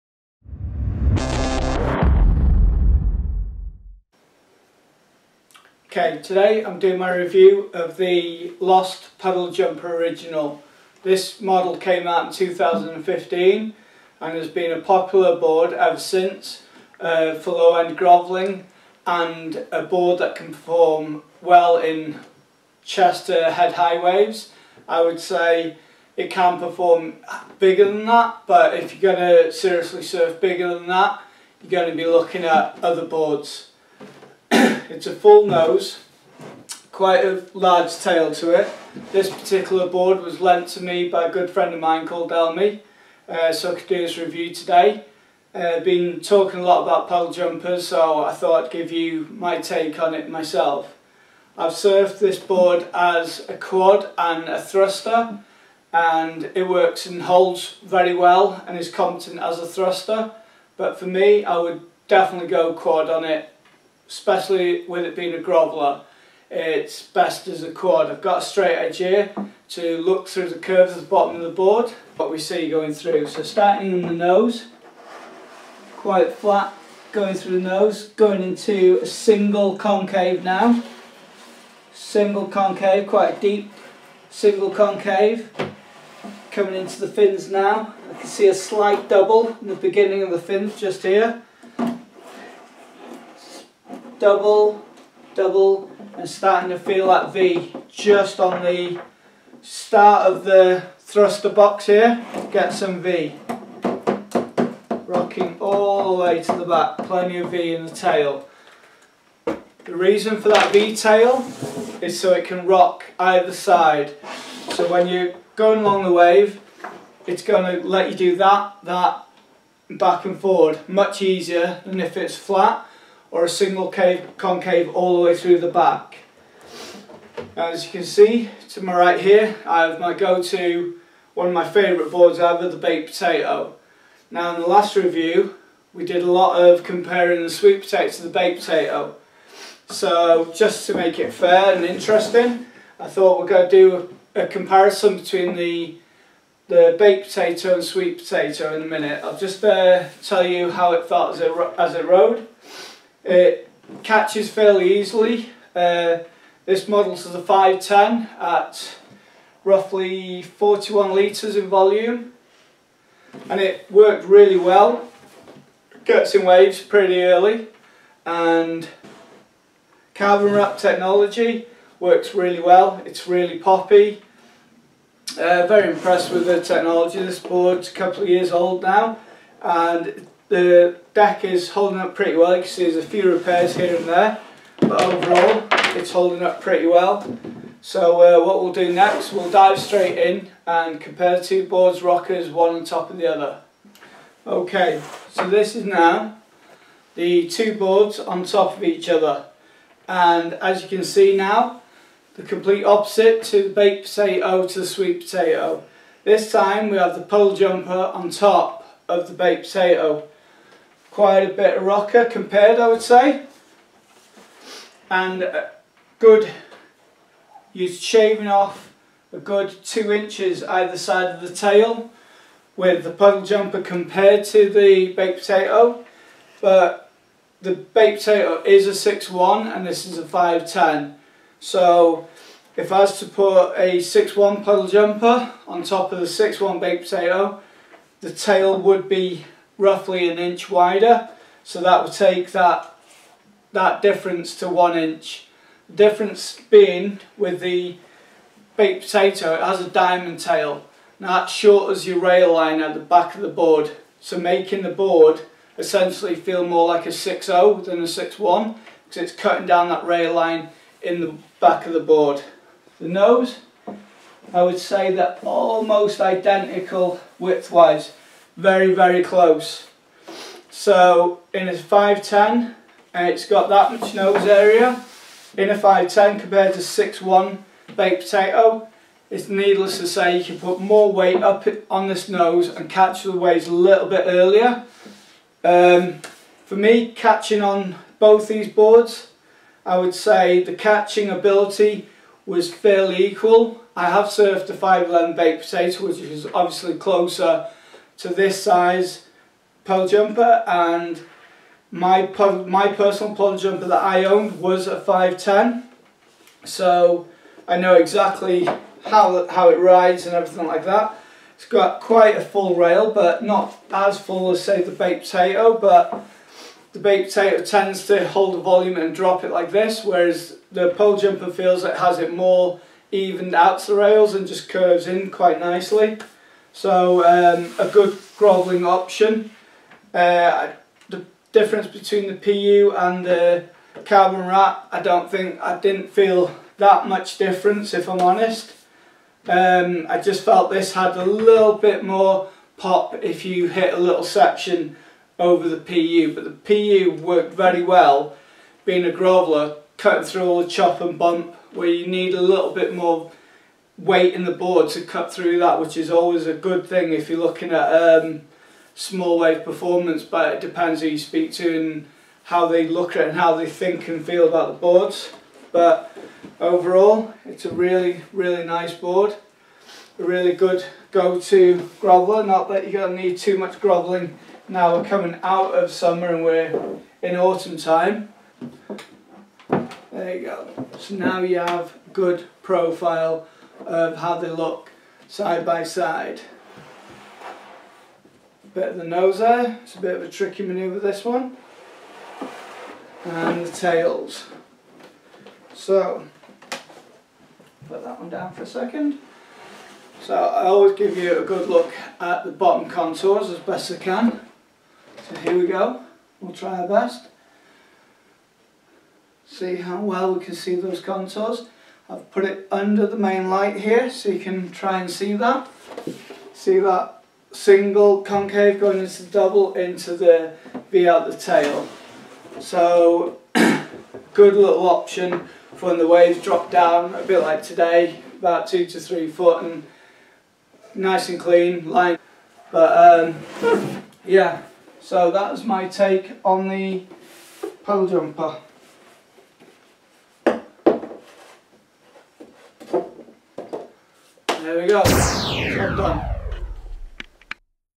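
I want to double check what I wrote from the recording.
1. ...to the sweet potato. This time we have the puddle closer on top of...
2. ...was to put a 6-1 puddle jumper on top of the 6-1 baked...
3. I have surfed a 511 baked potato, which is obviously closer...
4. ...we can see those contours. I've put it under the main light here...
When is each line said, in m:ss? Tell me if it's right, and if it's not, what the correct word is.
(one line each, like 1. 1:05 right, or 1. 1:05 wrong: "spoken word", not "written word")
1. 3:24 wrong: "jumper", not "closer"
2. 3:52 right
3. 4:53 right
4. 6:50 right.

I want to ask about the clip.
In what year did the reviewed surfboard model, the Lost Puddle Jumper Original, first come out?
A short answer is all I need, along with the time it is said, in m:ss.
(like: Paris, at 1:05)
2015, at 0:12.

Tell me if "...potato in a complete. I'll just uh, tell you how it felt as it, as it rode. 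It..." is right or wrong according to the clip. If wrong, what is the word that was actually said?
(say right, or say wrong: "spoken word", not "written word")
wrong: "minute", not "complete".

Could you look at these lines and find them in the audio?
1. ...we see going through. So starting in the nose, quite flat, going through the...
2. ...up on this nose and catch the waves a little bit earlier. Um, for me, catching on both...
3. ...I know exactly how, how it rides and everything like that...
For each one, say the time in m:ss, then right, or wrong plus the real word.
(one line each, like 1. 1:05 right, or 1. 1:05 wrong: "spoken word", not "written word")
1. 1:12 right
2. 4:41 right
3. 5:07 right.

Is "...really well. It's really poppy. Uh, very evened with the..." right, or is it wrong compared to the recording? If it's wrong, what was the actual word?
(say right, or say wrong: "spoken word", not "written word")
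wrong: "impressed", not "evened".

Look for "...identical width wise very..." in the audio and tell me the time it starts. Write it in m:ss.
4:26.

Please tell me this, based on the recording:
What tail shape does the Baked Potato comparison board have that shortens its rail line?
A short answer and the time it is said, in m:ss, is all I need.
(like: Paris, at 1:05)
Diamond tail, at 4:09.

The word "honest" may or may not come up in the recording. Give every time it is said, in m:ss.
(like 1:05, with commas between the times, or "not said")
5:38.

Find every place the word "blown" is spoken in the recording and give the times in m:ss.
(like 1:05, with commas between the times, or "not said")
not said.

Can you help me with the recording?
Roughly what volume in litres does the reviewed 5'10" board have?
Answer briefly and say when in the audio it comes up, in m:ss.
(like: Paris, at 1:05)
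41 litres, at 2:40.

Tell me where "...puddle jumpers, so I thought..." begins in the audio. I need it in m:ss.
0:47.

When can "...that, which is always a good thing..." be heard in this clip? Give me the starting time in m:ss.
5:55.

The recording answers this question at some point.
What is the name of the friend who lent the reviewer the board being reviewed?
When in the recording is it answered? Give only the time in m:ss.
0:42.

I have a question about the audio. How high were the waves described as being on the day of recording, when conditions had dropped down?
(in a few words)
2 to 3 foot.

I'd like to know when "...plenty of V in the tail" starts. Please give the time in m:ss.
1:46.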